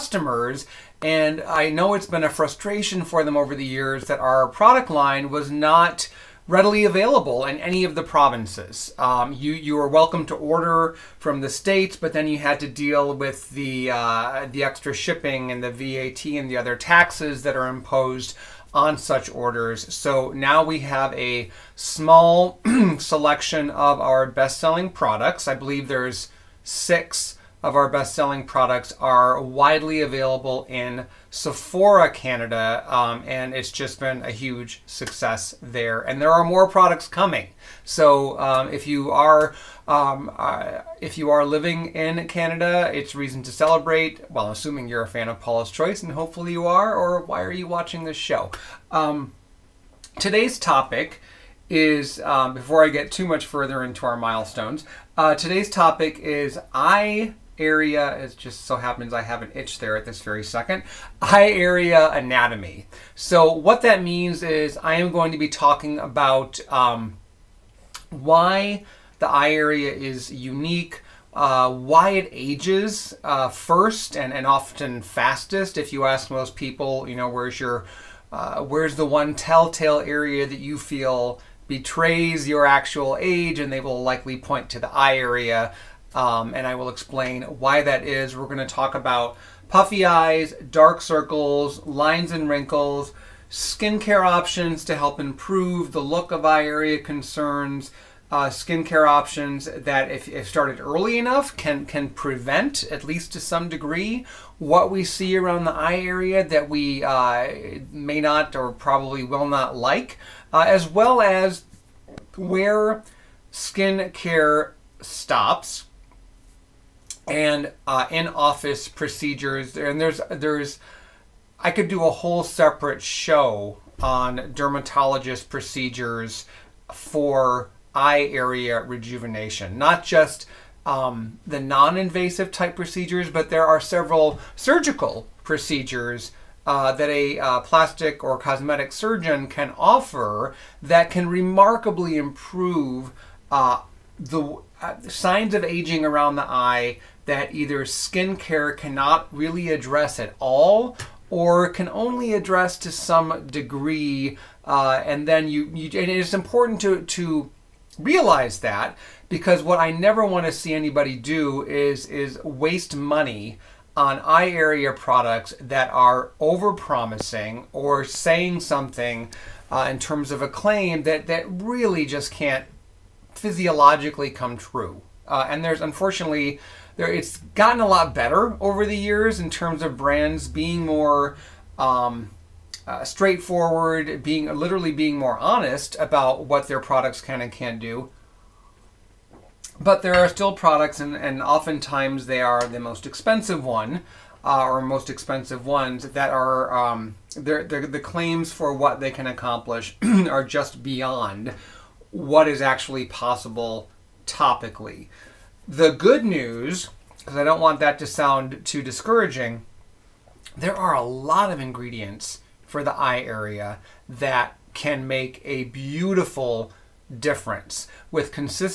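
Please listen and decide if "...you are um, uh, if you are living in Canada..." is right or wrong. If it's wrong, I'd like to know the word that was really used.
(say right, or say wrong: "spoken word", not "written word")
right.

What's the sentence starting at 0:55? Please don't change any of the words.
Uh, today's topic is eye area, it just so happens I have an itch there at this very second, eye area anatomy.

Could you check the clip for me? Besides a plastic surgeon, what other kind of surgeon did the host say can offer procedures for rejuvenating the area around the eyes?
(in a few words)
cosmetic surgeon.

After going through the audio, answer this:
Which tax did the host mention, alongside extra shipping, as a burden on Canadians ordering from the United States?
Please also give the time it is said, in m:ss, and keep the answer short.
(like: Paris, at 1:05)
VAT, at 0:15.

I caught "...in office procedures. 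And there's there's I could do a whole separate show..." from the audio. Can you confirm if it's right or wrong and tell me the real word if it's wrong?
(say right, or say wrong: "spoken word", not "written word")
right.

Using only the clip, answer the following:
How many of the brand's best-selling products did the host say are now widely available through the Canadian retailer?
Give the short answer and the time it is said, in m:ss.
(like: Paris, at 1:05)
6, at 0:26.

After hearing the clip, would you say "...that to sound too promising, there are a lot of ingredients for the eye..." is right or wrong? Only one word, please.
wrong.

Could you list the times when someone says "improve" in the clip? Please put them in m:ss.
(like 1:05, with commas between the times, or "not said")
1:35, 2:22.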